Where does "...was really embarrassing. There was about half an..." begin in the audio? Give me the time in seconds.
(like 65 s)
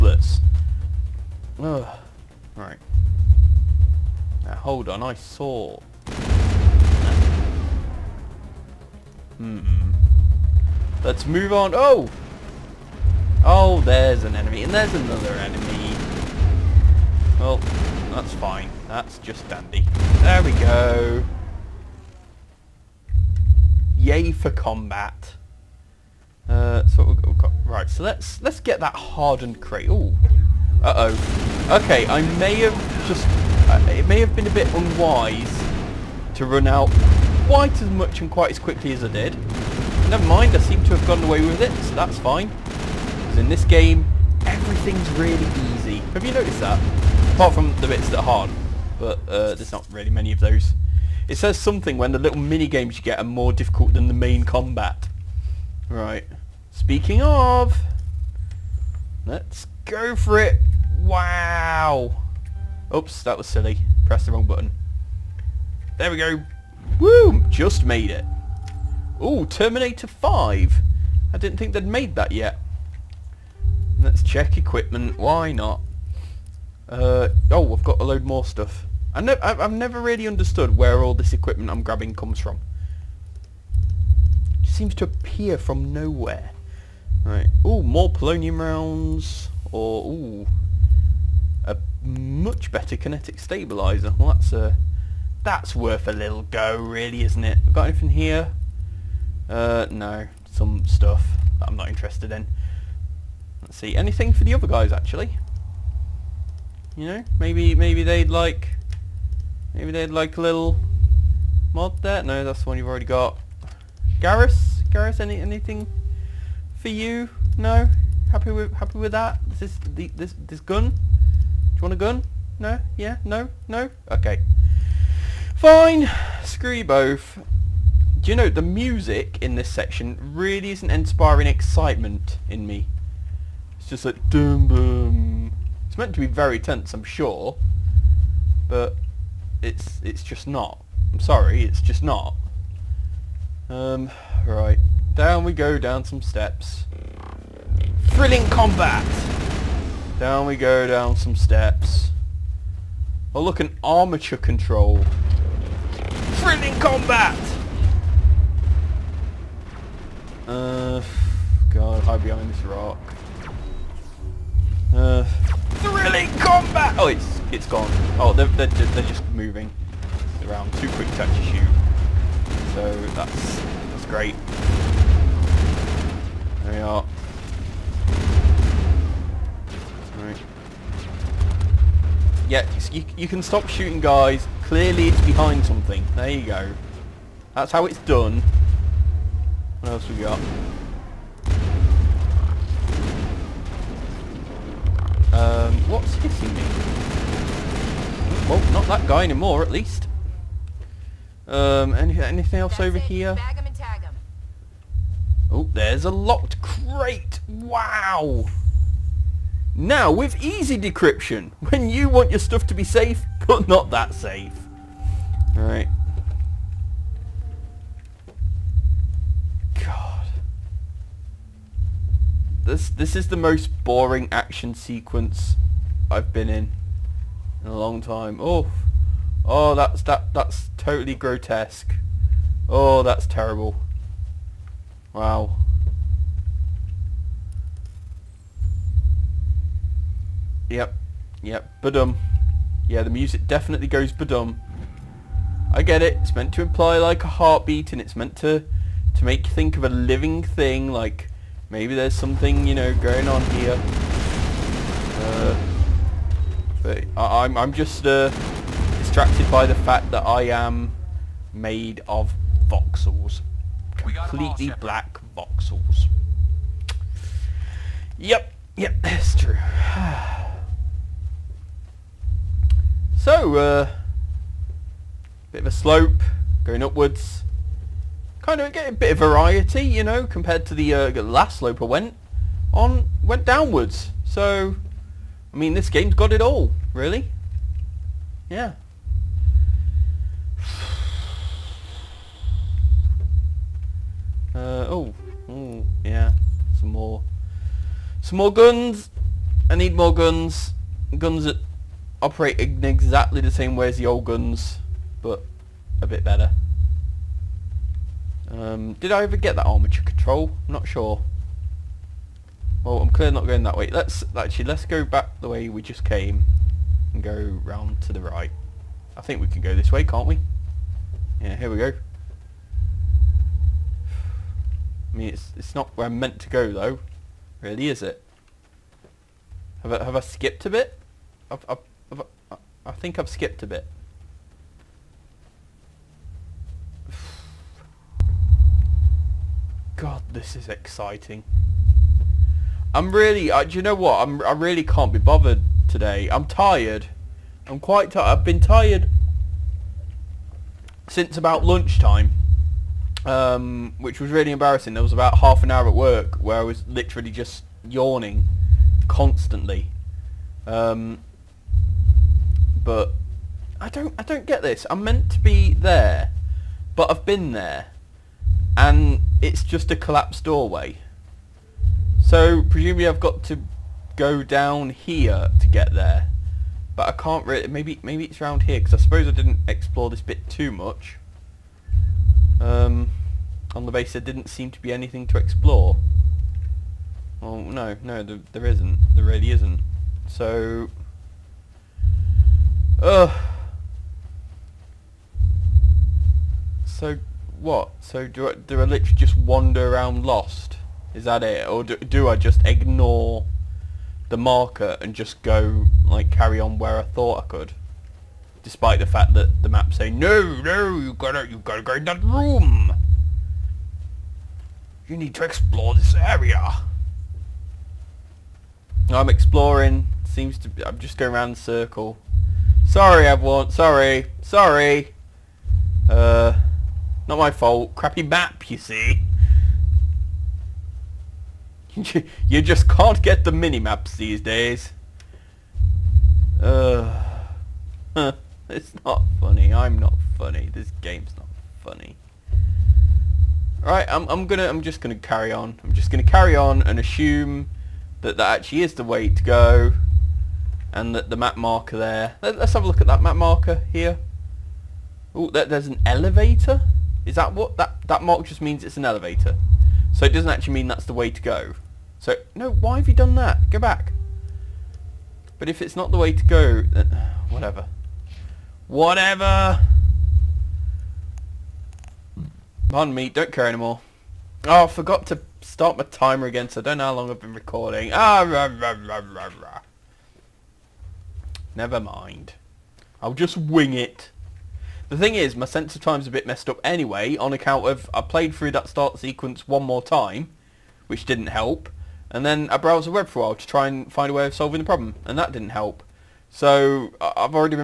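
354 s.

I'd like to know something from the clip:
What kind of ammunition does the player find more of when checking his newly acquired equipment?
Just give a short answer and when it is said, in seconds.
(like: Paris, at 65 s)
Polonium rounds, at 88 s.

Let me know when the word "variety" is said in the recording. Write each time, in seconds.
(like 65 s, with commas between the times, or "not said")
279 s.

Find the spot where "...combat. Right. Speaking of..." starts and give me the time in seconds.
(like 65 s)
54 s.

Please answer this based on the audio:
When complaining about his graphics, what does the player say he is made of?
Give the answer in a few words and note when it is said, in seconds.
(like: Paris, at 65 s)
Black voxels, at 264 s.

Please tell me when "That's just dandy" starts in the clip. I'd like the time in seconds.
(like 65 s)
18 s.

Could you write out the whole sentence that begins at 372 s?
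So presumably I've got to go down here to get there.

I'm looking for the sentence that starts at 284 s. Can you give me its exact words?
So, I mean, this game's got it all, really.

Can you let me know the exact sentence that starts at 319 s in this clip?
I think we can go this way, can't we?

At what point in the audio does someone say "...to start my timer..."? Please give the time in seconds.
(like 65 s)
475 s.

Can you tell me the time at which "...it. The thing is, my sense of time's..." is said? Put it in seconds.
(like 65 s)
483 s.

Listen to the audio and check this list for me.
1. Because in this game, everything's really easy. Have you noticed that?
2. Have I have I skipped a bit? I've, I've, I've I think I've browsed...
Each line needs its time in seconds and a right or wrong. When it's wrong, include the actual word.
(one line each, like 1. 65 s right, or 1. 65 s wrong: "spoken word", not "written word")
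1. 42 s right
2. 329 s wrong: "skipped", not "browsed".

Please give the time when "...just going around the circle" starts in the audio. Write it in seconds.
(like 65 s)
420 s.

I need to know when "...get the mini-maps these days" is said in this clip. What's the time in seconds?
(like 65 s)
433 s.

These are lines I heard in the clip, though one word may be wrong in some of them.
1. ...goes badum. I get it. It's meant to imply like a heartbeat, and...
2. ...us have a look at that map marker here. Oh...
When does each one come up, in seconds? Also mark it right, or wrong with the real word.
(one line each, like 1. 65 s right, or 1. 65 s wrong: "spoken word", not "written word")
1. 243 s right
2. 452 s right.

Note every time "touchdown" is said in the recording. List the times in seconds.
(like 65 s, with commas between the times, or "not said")
not said.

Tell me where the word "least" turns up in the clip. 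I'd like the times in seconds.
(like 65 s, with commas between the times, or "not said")
199 s.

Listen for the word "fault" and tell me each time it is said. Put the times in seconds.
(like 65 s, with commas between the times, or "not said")
427 s.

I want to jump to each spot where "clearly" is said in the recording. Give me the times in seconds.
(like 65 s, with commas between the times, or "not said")
184 s, 313 s.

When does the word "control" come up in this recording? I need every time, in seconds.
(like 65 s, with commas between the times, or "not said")
154 s, 310 s.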